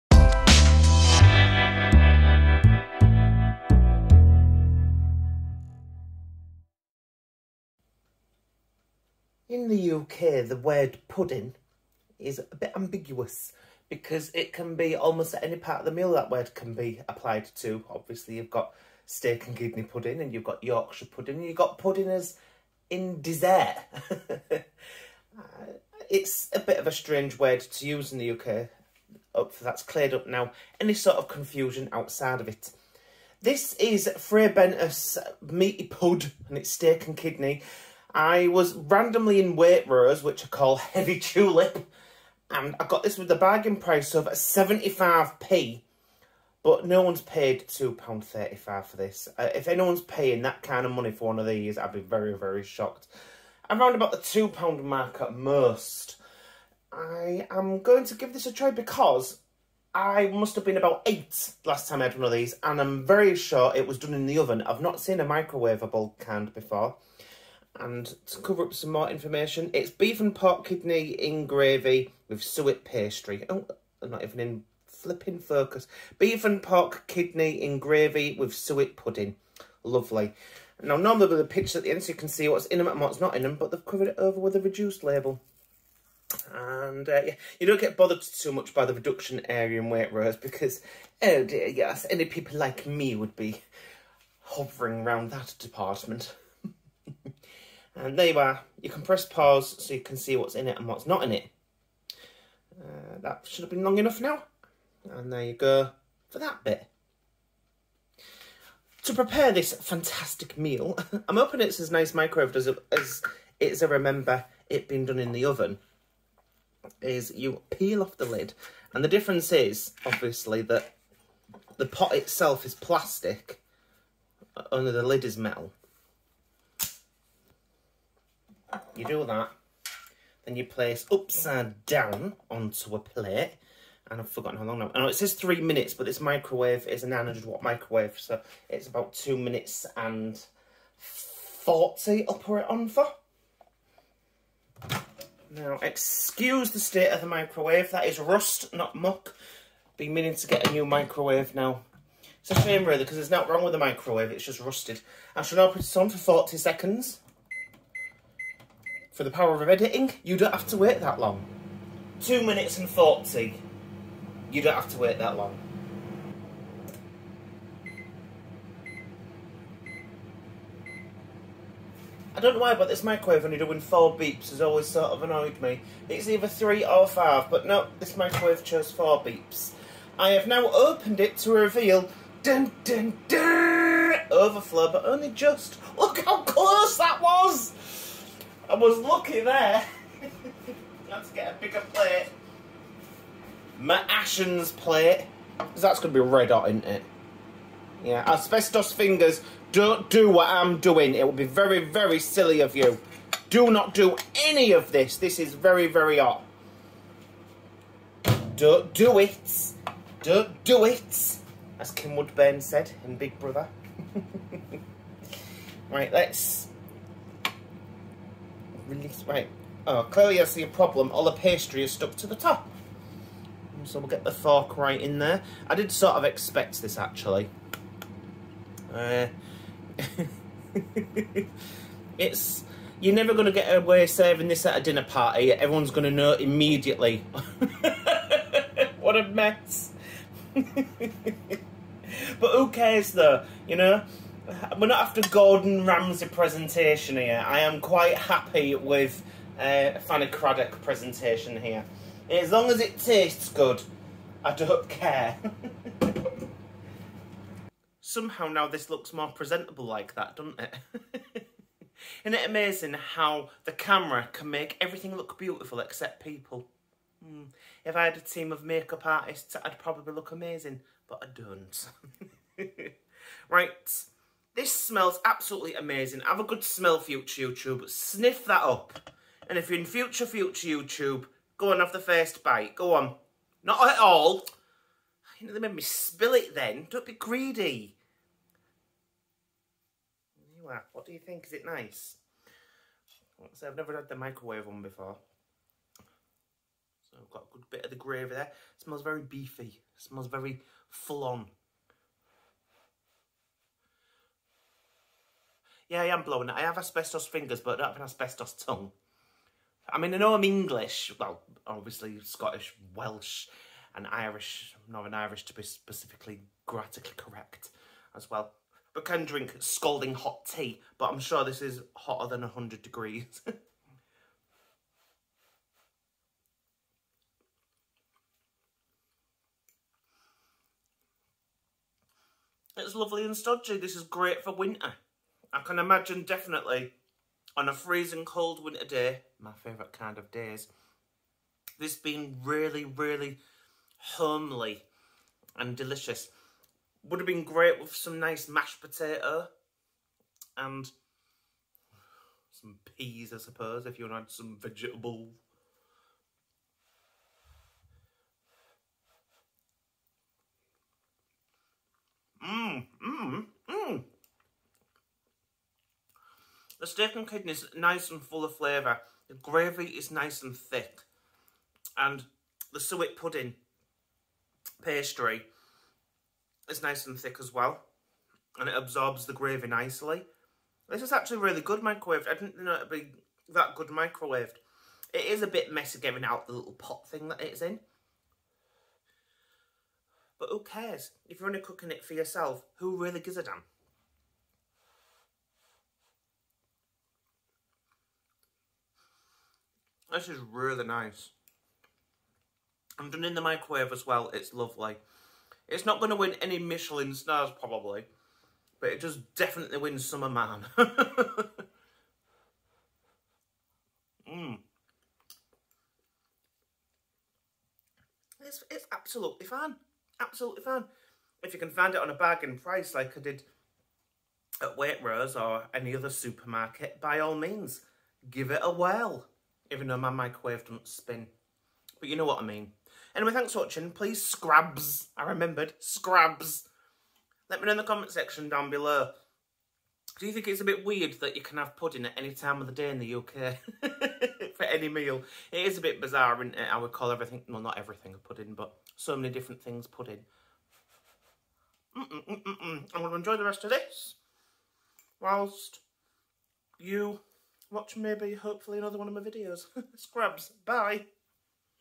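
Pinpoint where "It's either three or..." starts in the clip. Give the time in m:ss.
2:56.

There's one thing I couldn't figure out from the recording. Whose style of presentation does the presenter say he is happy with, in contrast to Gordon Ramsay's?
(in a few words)
Fanny Cradock.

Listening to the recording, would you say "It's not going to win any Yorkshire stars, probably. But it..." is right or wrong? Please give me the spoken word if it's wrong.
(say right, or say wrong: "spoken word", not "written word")
wrong: "Michelin", not "Yorkshire".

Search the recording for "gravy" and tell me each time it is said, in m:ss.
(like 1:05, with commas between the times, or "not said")
1:11, 1:17, 4:57, 6:09, 6:19.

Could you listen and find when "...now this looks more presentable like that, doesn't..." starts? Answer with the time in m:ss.
4:18.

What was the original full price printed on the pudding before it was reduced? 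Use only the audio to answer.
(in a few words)
£2.35.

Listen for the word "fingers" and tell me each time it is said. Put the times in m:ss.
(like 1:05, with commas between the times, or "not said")
3:18, 5:07.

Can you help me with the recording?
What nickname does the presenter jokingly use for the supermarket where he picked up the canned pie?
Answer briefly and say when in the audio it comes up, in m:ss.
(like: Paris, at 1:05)
Heavy Tulip, at 0:40.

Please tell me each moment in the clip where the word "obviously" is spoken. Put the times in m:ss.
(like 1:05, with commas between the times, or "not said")
0:17, 2:00, 5:11.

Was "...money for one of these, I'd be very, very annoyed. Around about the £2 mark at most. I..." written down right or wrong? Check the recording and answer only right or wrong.
wrong.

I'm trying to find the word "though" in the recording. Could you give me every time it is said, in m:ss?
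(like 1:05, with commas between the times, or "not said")
4:03, 7:09.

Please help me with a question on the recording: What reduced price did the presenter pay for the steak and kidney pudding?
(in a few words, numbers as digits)
75p.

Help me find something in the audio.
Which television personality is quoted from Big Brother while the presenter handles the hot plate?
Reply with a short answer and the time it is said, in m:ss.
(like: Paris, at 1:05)
Kim Woodburn, at 3:31.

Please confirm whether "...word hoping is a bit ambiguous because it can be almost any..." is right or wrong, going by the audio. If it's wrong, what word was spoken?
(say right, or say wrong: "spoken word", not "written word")
wrong: "pudding", not "hoping".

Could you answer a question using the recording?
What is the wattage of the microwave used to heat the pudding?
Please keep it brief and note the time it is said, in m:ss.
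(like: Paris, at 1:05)
900 watts, at 2:17.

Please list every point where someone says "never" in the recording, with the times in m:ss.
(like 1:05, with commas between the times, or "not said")
3:53, 4:53.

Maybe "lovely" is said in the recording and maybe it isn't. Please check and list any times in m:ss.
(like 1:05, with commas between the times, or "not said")
1:19, 5:32, 6:44.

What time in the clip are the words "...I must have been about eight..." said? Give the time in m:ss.
0:59.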